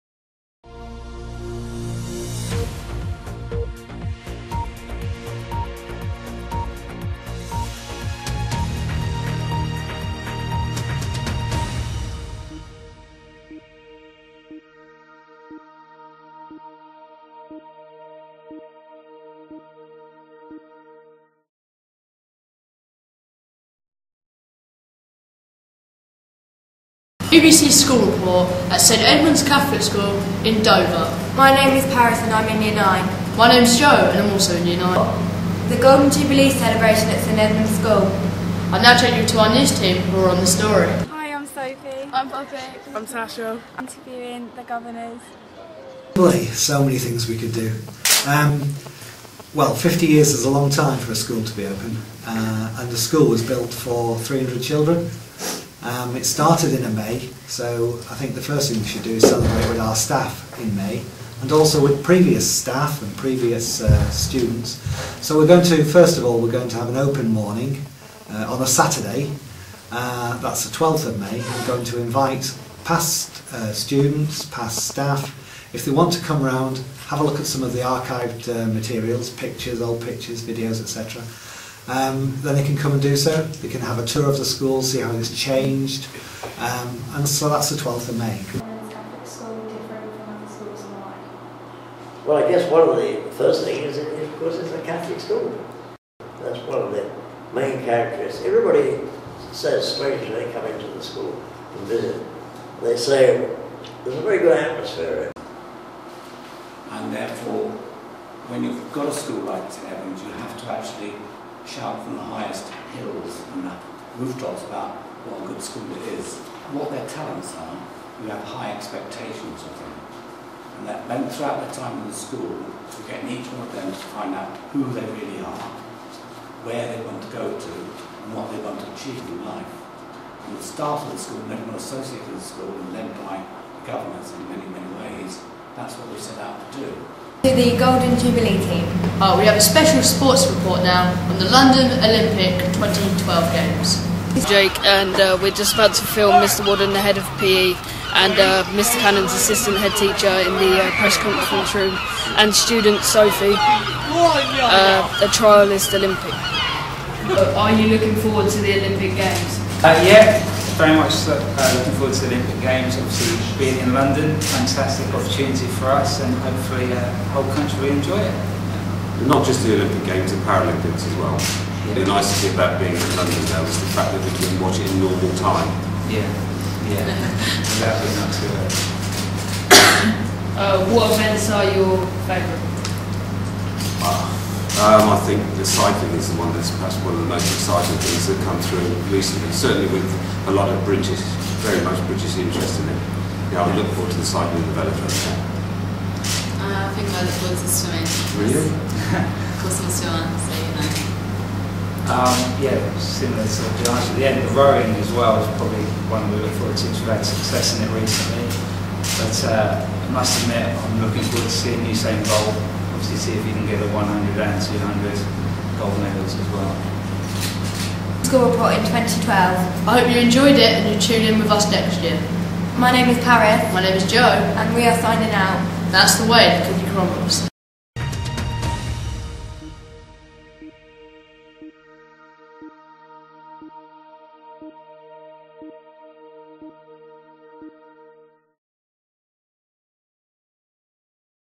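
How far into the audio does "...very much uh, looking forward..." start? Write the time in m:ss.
2:40.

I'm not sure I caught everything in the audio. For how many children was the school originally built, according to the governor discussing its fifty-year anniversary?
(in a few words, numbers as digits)
300.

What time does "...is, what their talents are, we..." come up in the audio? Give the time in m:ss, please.
1:56.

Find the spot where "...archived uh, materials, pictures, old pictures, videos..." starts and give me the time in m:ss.
1:17.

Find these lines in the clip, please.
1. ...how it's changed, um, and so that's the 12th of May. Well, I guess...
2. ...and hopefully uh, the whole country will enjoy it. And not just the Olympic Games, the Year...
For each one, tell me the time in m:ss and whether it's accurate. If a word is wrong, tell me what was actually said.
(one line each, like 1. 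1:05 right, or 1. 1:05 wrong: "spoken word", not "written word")
1. 1:25 right
2. 2:46 wrong: "Paralympics", not "Year".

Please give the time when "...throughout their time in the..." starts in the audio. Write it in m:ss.
2:01.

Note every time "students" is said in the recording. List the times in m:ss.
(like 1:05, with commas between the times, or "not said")
1:04, 1:13, 2:32.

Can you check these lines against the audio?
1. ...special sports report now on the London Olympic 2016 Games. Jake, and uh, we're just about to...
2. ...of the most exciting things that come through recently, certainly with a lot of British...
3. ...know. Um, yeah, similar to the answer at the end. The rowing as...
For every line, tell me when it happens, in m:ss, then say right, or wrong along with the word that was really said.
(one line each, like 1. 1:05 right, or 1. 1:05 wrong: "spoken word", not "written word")
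1. 2:19 wrong: "2012", not "2016"
2. 3:07 right
3. 3:20 right.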